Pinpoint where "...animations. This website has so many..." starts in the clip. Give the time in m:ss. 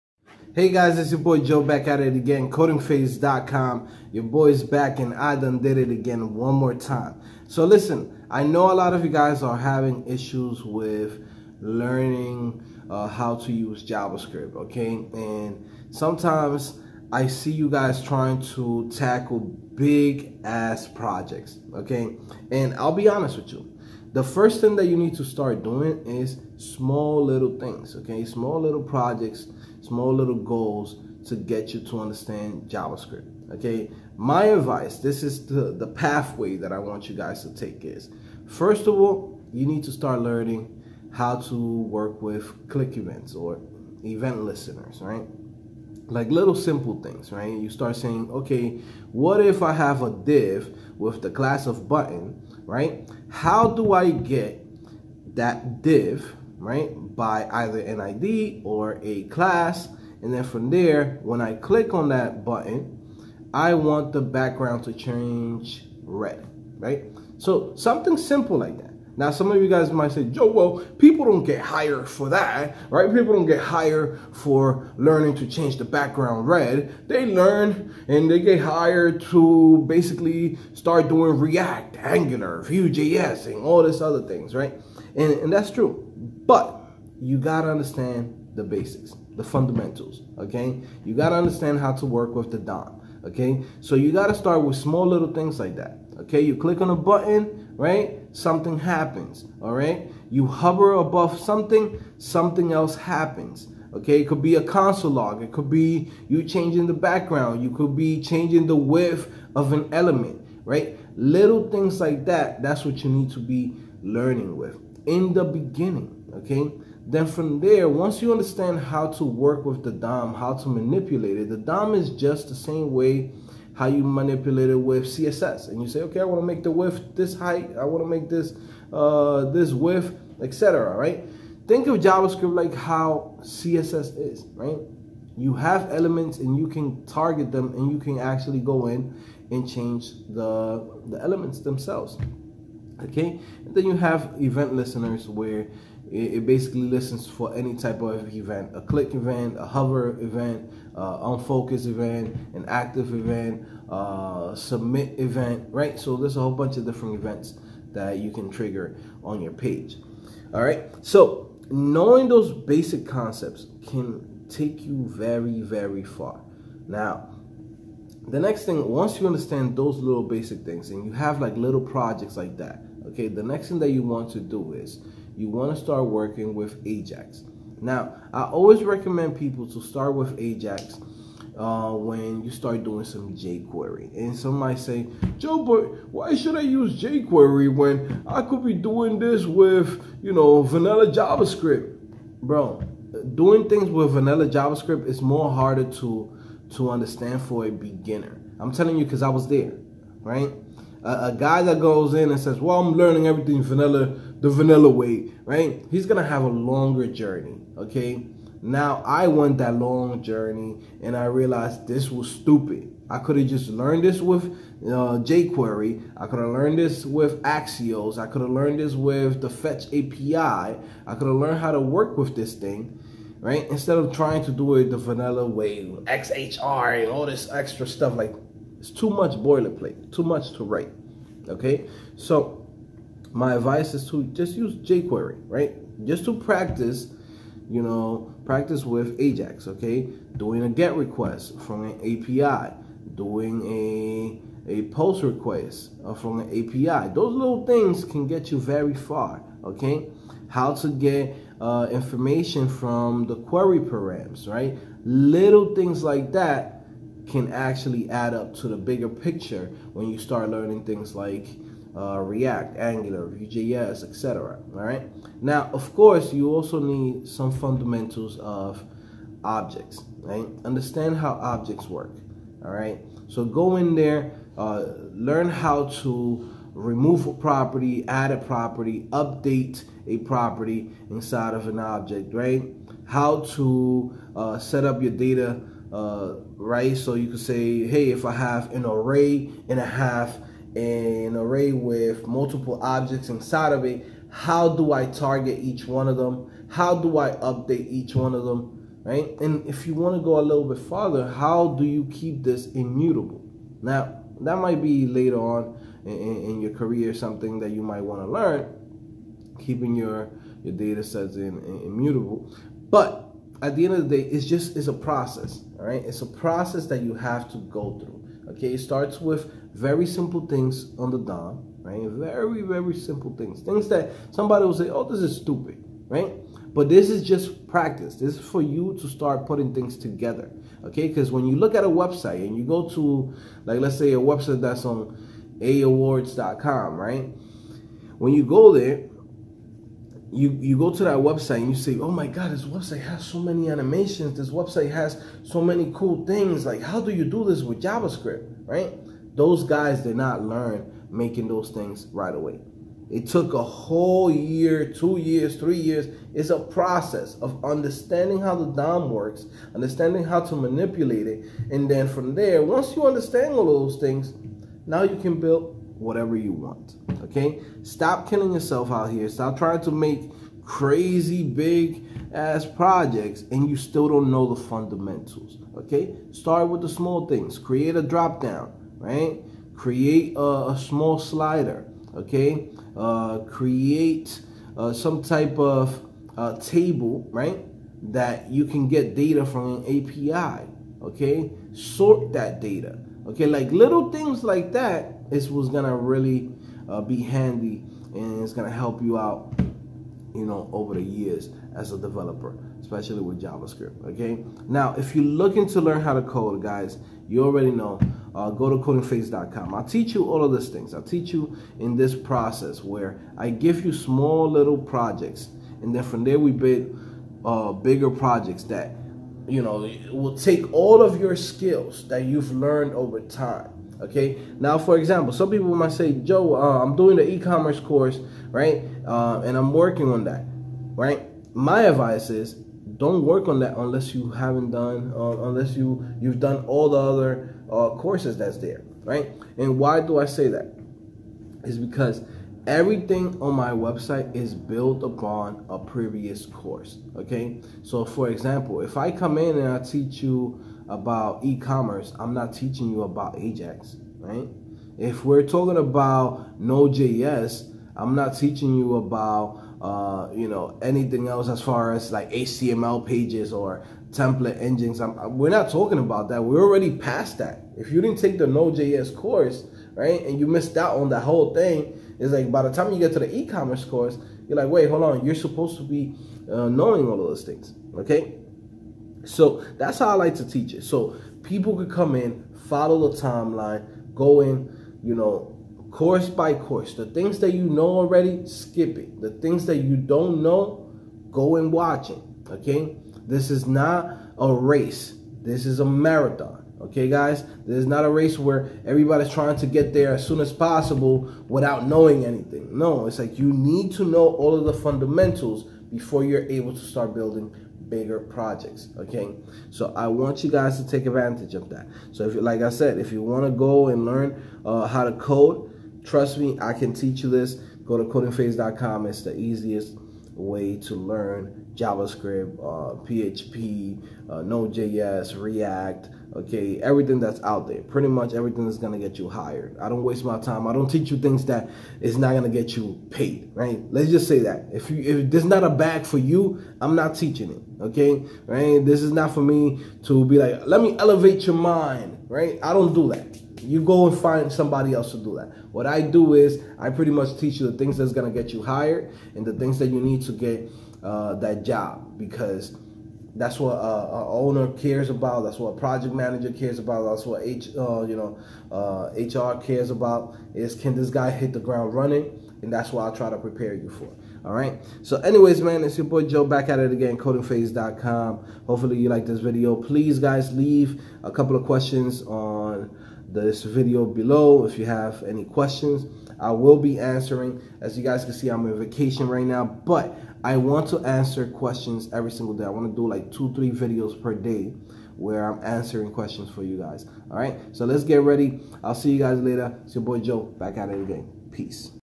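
5:43.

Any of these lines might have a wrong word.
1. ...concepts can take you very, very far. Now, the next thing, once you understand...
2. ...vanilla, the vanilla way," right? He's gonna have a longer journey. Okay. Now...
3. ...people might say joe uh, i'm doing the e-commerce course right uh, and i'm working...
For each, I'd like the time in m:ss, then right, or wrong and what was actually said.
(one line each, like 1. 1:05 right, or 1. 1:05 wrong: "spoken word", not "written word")
1. 2:43 right
2. 3:23 right
3. 7:05 right.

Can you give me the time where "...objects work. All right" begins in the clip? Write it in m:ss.
4:31.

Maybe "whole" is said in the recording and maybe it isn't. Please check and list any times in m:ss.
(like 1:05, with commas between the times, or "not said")
2:36, 5:53, 7:51.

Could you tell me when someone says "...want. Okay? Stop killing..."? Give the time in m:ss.
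6:06.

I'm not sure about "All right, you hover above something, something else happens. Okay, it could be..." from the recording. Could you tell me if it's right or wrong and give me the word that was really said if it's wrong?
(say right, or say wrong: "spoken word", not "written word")
right.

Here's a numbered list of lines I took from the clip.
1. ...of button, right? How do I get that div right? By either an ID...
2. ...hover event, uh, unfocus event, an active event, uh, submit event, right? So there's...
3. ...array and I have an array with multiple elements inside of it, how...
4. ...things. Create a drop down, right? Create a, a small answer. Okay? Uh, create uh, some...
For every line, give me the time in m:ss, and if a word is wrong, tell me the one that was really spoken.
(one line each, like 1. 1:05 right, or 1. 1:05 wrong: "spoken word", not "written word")
1. 0:51 right
2. 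2:29 right
3. 4:48 wrong: "objects", not "elements"
4. 6:17 wrong: "slider", not "answer".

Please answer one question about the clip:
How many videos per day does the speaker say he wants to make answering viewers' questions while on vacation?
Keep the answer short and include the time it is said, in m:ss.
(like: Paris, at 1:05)
2 or 3, at 9:43.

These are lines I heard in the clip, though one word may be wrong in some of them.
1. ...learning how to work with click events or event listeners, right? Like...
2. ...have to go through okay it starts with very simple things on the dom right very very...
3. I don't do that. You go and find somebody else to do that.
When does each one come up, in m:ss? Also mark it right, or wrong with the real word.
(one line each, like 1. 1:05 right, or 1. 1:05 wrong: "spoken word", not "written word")
1. 0:40 right
2. 5:17 right
3. 9:02 right.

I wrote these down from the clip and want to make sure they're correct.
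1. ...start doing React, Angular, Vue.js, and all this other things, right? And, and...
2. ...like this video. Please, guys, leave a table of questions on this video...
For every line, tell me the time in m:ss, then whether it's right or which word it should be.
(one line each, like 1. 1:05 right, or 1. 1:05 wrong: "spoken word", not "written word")
1. 1:20 right
2. 9:29 wrong: "couple", not "table".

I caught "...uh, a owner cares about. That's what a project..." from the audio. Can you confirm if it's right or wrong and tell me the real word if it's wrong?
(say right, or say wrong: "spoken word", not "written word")
right.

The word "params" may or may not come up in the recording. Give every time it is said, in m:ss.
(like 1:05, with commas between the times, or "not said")
4:13.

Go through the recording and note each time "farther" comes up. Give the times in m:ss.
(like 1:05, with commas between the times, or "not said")
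5:00.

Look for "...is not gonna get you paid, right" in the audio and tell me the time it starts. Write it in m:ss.
8:52.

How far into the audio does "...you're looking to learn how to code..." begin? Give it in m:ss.
6:45.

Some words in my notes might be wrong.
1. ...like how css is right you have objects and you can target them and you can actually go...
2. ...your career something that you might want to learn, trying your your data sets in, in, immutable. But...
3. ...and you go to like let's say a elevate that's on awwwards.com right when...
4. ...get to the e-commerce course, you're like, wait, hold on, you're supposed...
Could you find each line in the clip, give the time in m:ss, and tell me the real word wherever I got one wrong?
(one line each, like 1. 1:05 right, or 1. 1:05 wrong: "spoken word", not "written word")
1. 2:12 wrong: "elements", not "objects"
2. 5:06 wrong: "keeping", not "trying"
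3. 5:32 wrong: "website", not "elevate"
4. 7:52 right.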